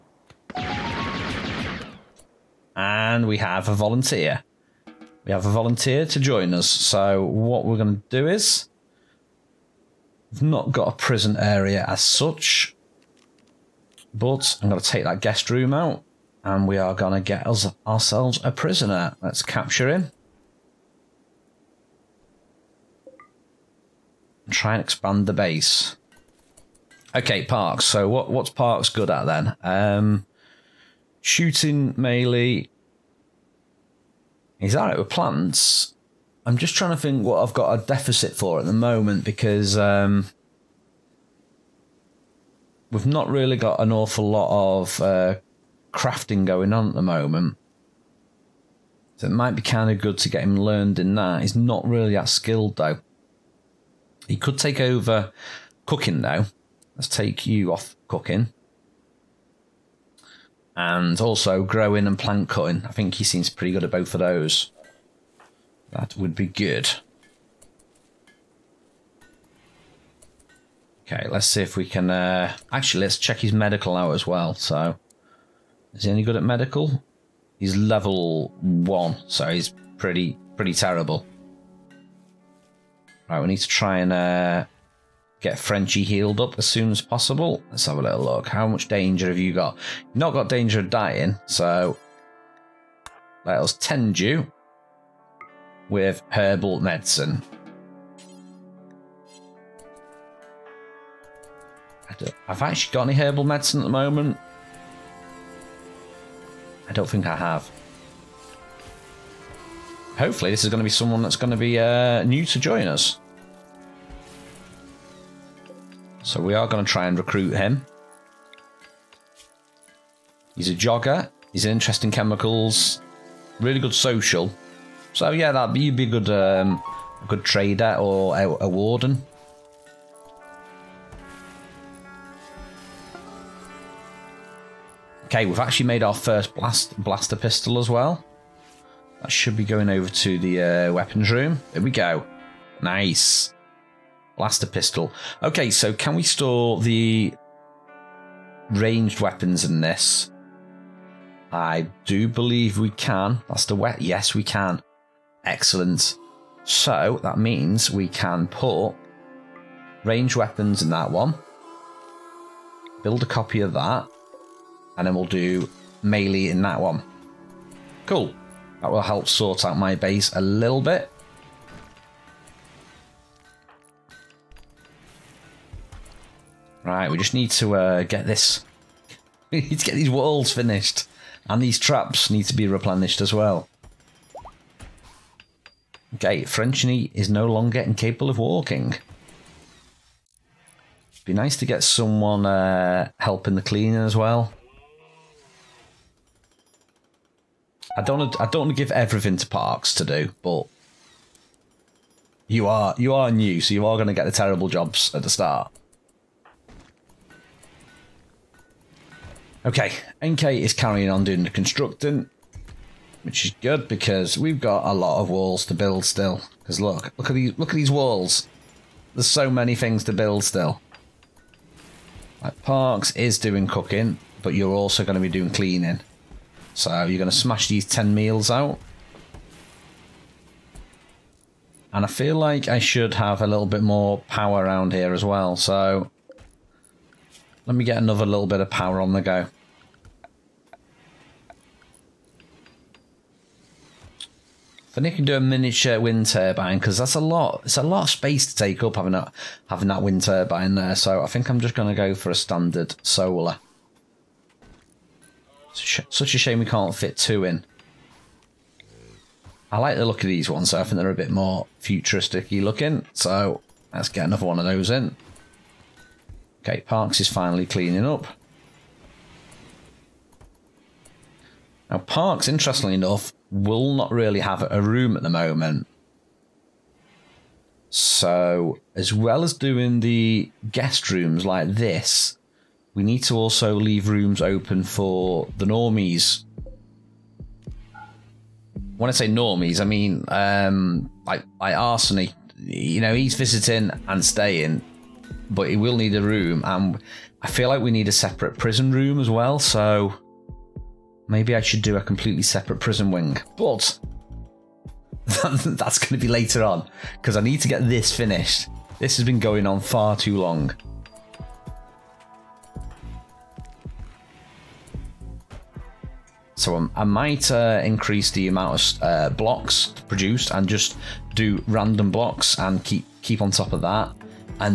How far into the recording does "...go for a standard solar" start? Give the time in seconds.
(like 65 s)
251 s.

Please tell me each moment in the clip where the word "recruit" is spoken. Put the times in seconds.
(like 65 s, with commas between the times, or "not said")
117 s.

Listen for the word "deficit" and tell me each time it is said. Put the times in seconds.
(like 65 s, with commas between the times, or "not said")
37 s.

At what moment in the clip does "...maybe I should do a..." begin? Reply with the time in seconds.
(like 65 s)
301 s.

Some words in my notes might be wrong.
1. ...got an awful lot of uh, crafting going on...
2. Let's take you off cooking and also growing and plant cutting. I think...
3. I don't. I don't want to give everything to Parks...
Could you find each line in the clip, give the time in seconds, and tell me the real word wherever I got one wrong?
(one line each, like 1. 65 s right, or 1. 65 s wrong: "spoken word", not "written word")
1. 43 s right
2. 56 s right
3. 197 s right.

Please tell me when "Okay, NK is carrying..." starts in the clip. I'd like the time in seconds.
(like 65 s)
209 s.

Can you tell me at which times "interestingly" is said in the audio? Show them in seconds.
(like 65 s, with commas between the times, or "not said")
272 s.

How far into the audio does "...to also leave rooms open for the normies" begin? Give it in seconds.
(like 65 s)
283 s.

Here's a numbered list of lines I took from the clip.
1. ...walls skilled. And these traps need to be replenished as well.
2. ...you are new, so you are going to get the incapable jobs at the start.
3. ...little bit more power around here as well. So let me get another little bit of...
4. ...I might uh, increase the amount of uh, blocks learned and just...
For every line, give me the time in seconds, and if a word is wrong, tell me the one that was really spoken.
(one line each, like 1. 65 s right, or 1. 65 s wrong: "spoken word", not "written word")
1. 180 s wrong: "finished", not "skilled"
2. 202 s wrong: "terrible", not "incapable"
3. 233 s right
4. 316 s wrong: "produced", not "learned".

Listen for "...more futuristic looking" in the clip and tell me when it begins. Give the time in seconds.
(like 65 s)
261 s.